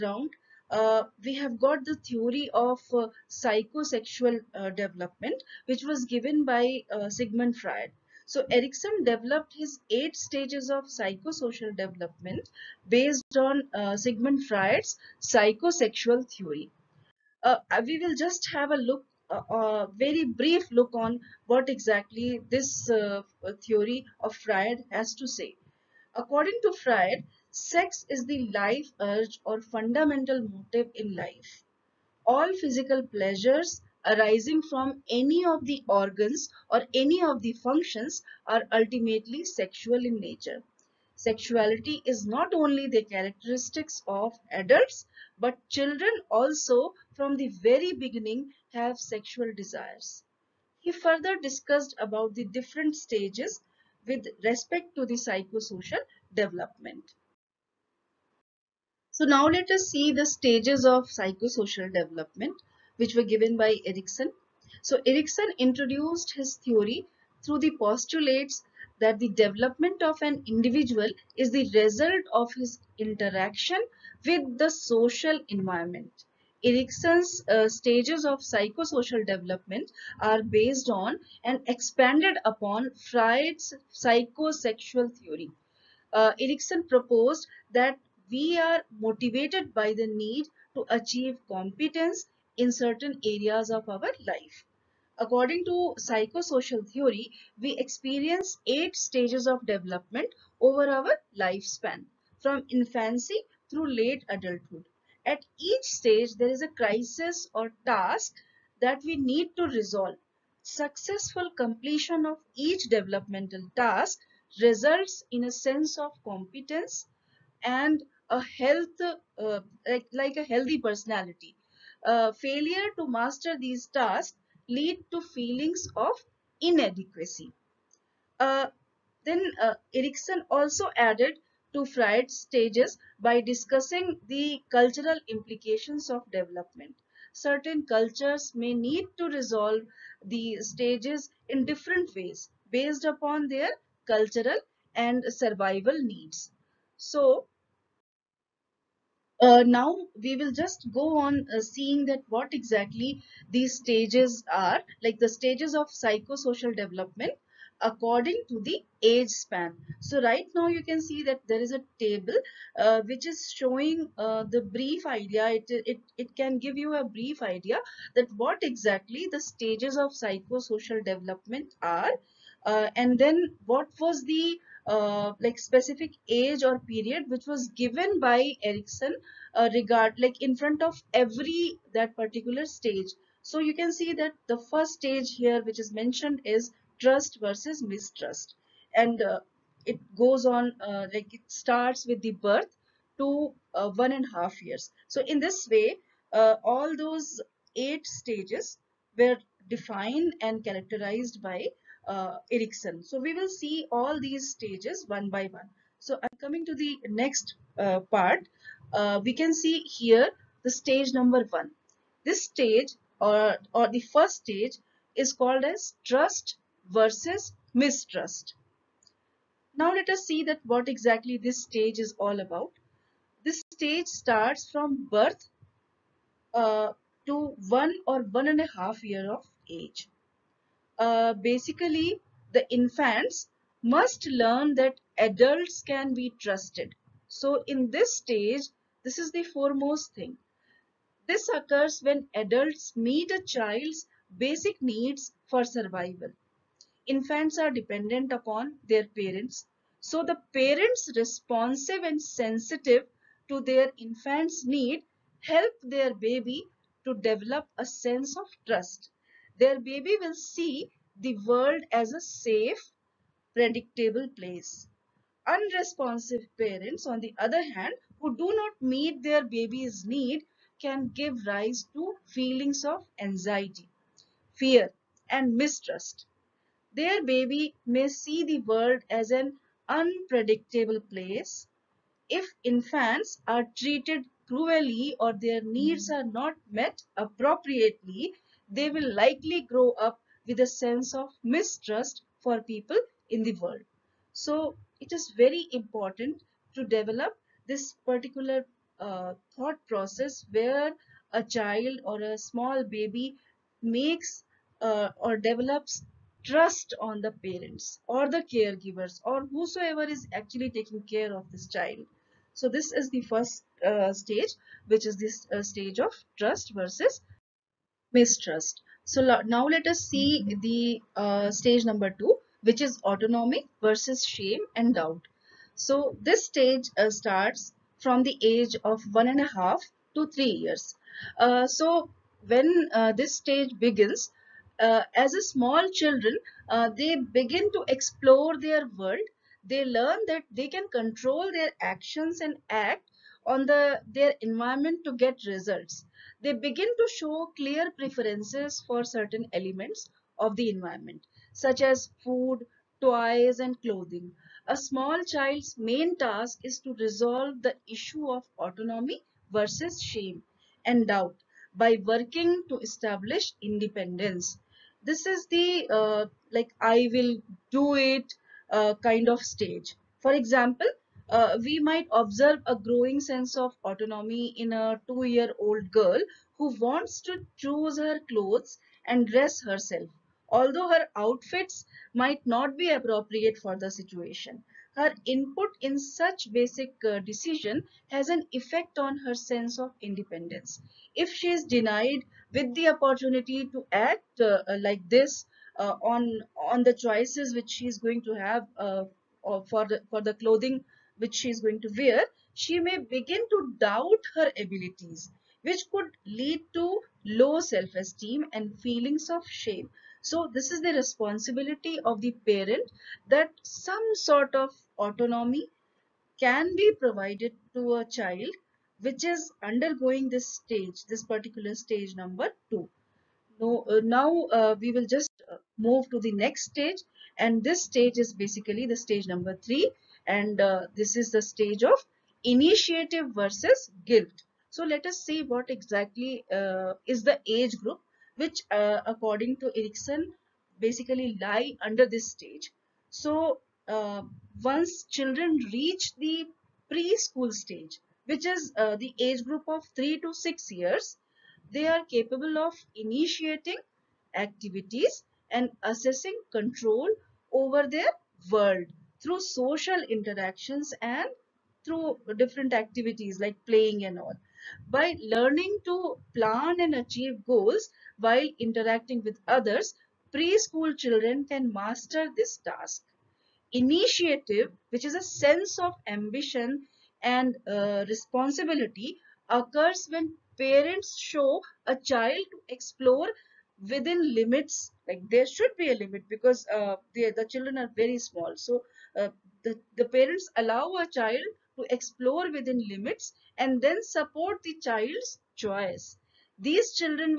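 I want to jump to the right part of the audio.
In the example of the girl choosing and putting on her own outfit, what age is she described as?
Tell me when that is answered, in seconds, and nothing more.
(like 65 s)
375 s.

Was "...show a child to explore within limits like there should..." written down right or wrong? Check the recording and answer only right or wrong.
right.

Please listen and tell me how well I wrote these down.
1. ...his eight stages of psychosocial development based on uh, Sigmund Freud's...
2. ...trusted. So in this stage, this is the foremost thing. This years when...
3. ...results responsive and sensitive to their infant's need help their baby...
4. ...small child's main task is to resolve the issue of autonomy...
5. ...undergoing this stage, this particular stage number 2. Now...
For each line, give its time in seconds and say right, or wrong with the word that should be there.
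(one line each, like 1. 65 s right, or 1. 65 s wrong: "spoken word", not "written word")
1. 9 s right
2. 236 s wrong: "occurs", not "years"
3. 250 s wrong: "parents", not "results"
4. 354 s right
5. 419 s right.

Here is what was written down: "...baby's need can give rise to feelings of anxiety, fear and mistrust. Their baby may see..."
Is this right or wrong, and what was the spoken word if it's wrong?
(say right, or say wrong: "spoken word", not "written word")
right.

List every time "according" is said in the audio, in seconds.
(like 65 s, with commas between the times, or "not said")
26 s, 95 s, 157 s, 439 s.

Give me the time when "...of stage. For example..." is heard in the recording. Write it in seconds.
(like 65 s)
369 s.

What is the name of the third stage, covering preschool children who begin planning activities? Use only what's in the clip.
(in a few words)
Initiative versus guilt.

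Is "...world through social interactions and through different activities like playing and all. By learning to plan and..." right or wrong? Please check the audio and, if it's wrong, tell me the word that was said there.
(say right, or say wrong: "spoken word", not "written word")
right.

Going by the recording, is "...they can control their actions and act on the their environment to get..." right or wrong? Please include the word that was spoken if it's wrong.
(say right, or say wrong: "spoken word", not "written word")
right.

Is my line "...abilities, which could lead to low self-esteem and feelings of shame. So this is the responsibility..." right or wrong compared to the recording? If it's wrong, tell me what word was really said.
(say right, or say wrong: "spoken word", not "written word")
right.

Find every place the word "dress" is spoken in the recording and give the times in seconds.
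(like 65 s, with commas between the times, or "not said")
379 s.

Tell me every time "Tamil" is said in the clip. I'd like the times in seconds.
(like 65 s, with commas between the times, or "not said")
not said.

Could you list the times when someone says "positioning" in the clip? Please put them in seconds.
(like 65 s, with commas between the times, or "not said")
not said.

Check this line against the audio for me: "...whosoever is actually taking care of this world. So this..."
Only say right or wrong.
wrong.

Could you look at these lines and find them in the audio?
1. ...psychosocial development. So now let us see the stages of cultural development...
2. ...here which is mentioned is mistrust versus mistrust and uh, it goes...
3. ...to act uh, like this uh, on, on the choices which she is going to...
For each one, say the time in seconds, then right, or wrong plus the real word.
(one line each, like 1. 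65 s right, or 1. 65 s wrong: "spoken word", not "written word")
1. 55 s wrong: "psychosocial", not "cultural"
2. 185 s wrong: "trust", not "mistrust"
3. 393 s right.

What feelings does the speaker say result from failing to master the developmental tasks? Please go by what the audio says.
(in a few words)
Feelings of inadequacy.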